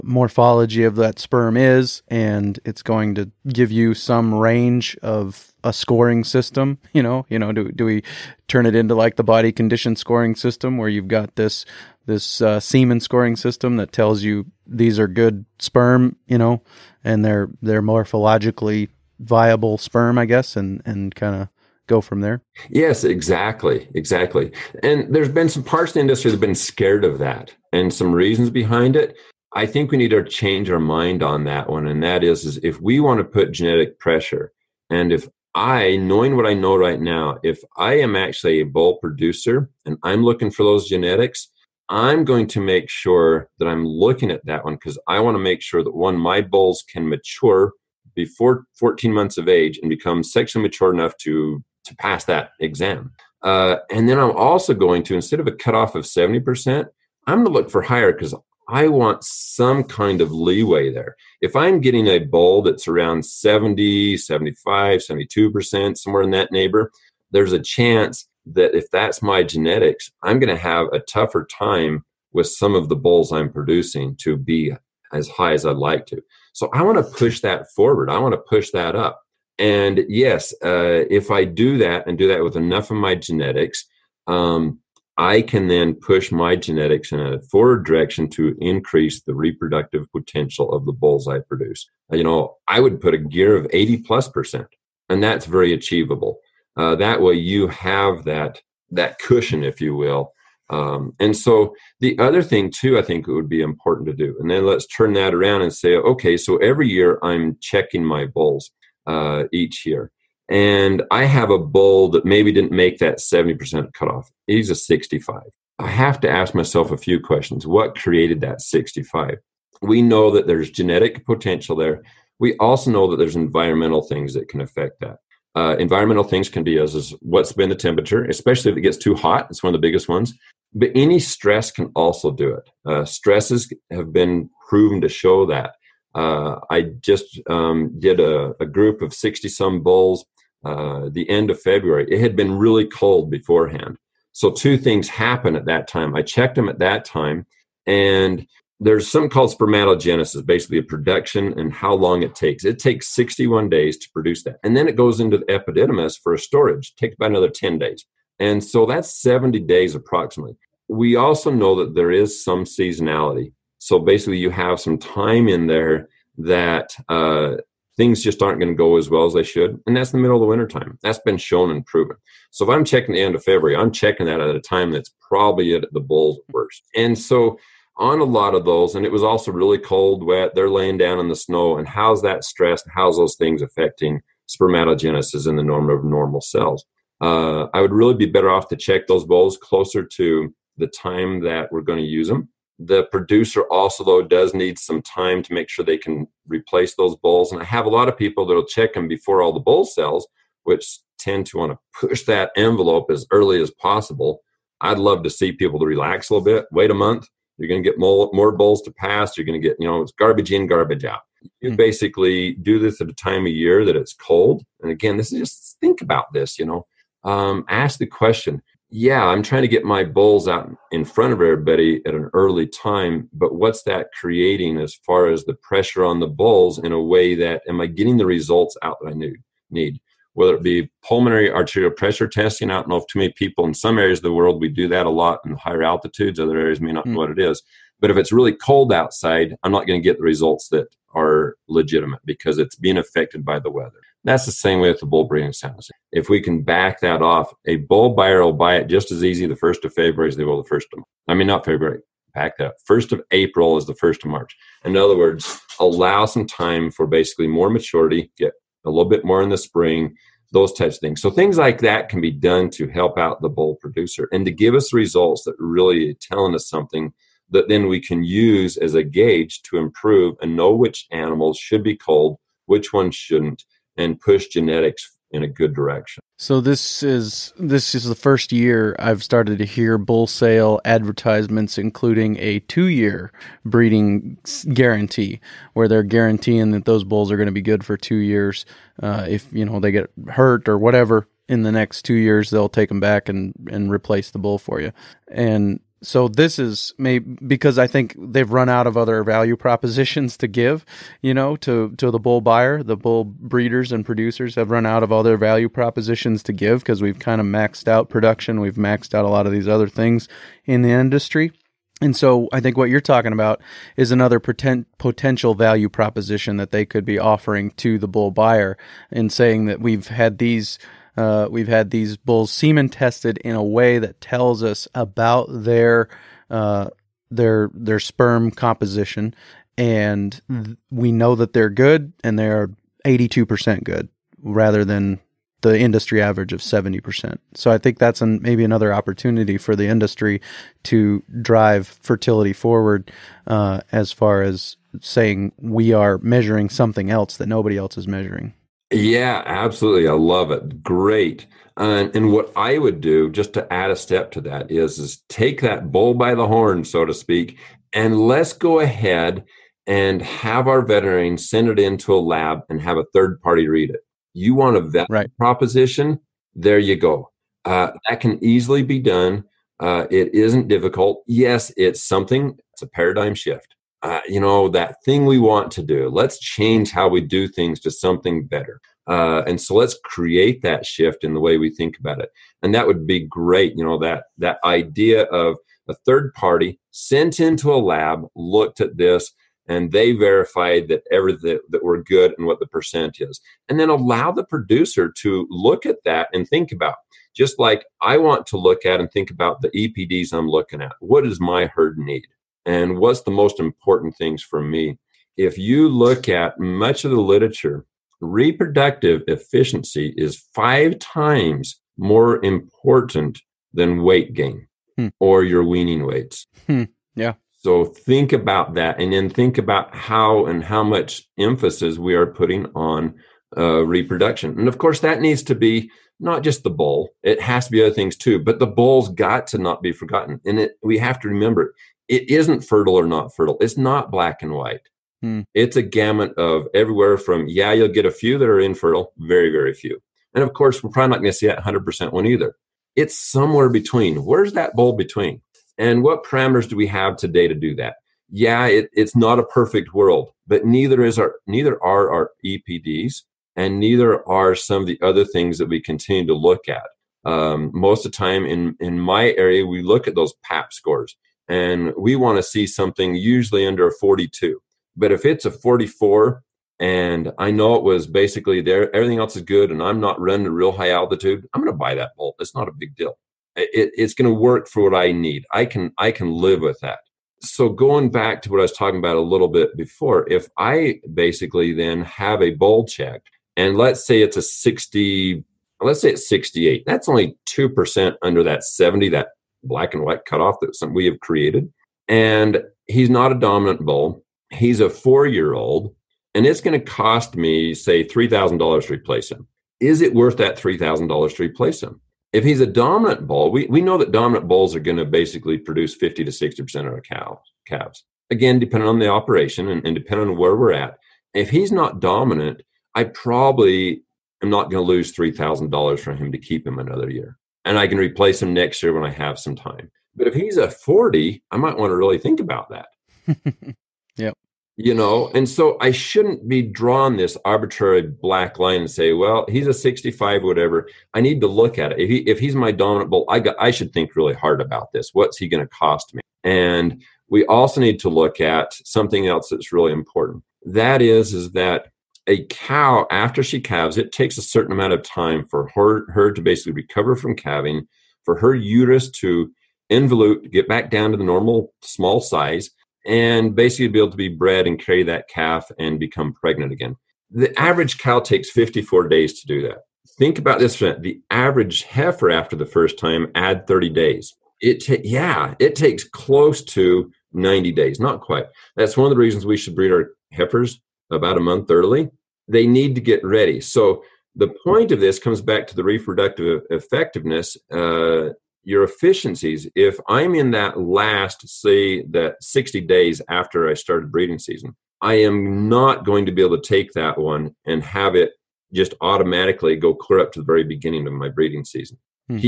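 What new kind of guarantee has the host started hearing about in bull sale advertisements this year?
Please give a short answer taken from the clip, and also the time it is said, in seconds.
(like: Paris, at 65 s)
Two-year breeding guarantee, at 282 s.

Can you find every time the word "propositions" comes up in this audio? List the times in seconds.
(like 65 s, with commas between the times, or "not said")
299 s, 305 s, 315 s, 365 s.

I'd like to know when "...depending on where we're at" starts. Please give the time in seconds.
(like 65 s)
509 s.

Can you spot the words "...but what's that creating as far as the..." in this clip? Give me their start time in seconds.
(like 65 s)
223 s.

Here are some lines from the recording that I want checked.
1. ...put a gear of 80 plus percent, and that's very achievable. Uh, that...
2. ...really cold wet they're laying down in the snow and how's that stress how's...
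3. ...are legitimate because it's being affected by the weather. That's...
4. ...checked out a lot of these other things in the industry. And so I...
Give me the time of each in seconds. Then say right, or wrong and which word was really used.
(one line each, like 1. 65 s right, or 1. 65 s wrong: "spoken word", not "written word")
1. 93 s right
2. 179 s right
3. 241 s right
4. 308 s wrong: "maxed", not "checked".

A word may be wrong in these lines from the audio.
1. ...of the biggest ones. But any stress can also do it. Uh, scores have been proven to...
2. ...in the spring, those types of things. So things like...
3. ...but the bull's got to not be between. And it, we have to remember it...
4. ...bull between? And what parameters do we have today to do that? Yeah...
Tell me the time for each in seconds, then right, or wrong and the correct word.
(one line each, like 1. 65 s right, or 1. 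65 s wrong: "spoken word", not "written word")
1. 129 s wrong: "stresses", not "scores"
2. 259 s right
3. 428 s wrong: "forgotten", not "between"
4. 444 s right.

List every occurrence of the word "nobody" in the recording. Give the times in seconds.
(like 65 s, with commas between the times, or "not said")
347 s.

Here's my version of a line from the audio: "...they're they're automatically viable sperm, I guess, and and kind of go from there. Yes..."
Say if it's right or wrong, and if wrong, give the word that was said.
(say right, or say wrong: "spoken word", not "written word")
wrong: "morphologically", not "automatically".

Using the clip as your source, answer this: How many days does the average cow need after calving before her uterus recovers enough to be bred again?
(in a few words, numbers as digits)
54 days.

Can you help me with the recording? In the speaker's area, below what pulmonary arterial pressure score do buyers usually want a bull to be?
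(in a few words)
42.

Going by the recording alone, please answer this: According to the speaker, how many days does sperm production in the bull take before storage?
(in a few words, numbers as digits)
61 days.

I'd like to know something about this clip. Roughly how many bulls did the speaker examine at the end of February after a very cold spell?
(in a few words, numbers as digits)
60.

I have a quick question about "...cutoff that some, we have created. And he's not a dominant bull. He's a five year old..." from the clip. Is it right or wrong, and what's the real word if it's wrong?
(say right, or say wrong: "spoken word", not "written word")
wrong: "four", not "five".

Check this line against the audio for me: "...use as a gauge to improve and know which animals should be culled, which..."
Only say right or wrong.
right.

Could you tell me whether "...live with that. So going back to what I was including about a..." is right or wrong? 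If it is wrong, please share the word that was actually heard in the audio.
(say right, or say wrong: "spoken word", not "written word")
wrong: "talking", not "including".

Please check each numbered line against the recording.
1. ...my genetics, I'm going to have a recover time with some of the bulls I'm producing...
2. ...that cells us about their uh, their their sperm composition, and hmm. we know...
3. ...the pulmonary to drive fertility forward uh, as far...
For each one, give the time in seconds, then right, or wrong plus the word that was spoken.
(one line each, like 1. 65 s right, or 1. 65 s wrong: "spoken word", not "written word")
1. 69 s wrong: "tougher", not "recover"
2. 323 s wrong: "tells", not "cells"
3. 339 s wrong: "industry", not "pulmonary".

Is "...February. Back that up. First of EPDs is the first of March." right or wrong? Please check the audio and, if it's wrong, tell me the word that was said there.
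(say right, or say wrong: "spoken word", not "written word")
wrong: "April", not "EPDs".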